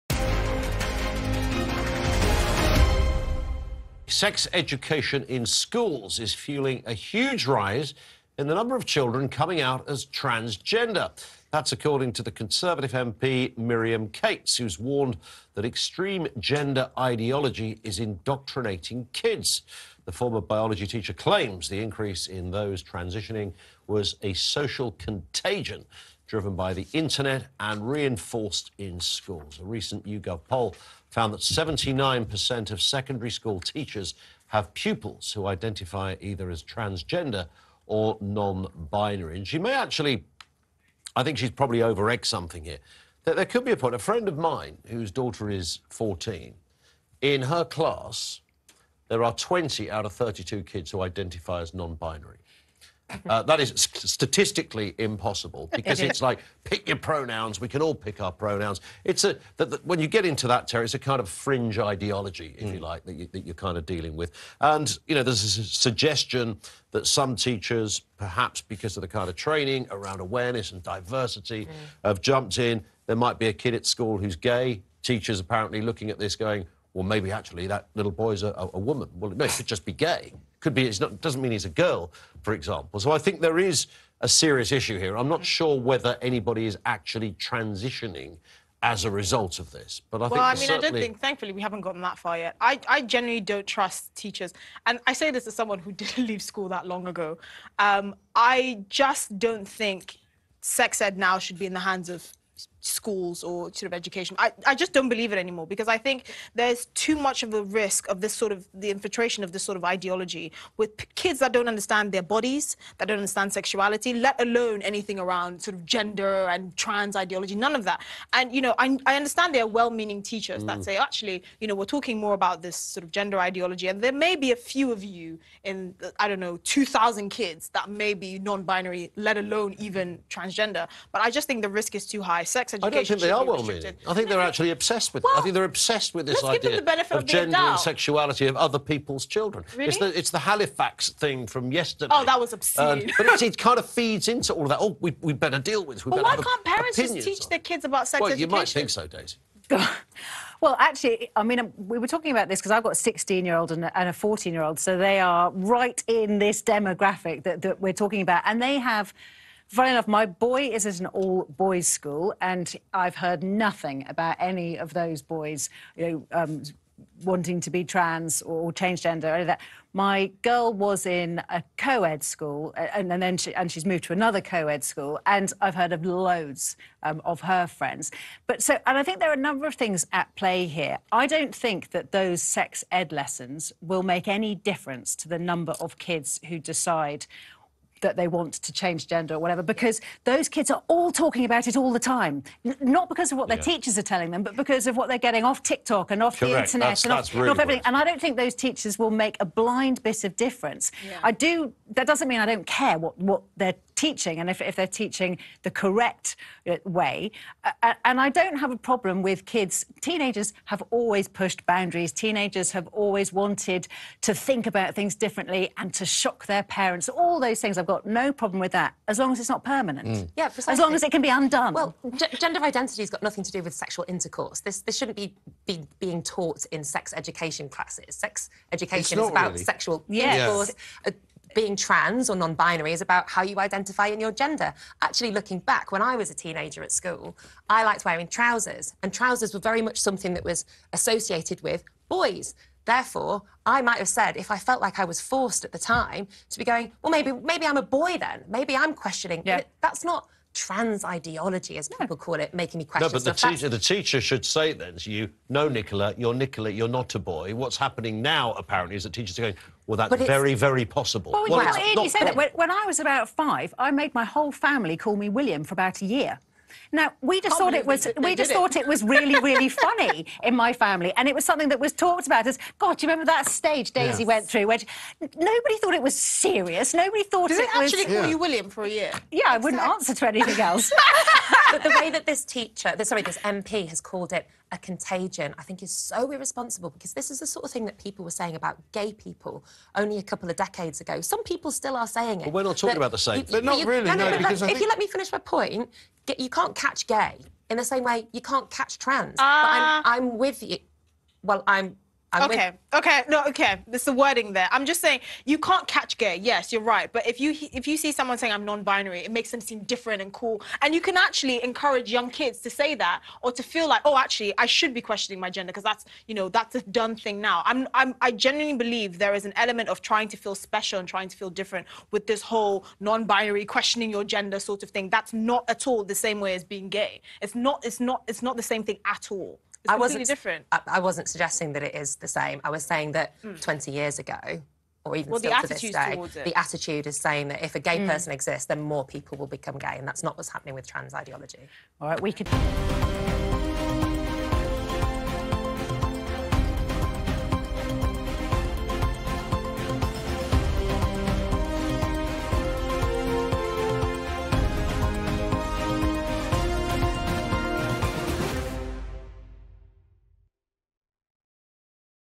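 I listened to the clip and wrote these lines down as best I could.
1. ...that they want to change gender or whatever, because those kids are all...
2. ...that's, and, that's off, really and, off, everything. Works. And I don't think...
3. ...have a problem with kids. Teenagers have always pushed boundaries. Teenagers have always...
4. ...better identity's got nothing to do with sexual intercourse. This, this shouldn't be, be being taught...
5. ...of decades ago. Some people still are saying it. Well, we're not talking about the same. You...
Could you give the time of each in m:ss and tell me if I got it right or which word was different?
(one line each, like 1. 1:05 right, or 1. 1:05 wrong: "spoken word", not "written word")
1. 3:08 right
2. 3:16 right
3. 3:28 right
4. 3:42 wrong: "gender", not "better"
5. 4:50 right.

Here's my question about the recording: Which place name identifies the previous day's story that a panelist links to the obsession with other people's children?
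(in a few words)
Halifax.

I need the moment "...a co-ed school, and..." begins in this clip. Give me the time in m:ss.
2:51.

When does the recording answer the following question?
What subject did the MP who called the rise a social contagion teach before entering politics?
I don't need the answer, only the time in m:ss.
0:20.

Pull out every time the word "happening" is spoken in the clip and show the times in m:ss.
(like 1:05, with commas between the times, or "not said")
4:17, 5:40.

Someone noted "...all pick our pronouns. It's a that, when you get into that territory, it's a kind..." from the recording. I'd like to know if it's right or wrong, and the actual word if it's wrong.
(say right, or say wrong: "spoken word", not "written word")
right.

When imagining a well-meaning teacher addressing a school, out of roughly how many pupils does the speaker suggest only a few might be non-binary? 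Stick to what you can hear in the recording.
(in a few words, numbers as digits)
2,000.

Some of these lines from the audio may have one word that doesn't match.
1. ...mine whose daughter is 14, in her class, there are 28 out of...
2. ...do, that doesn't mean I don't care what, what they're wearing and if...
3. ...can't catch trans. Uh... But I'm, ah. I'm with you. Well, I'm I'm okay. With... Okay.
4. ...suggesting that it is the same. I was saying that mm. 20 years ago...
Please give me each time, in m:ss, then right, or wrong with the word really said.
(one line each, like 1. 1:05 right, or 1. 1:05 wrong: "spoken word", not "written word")
1. 0:44 wrong: "20", not "28"
2. 3:21 wrong: "teaching", not "wearing"
3. 4:58 right
4. 5:31 right.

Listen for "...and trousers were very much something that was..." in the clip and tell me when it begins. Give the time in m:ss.
3:59.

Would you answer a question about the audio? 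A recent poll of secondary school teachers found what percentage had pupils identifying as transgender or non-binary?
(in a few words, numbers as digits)
79%.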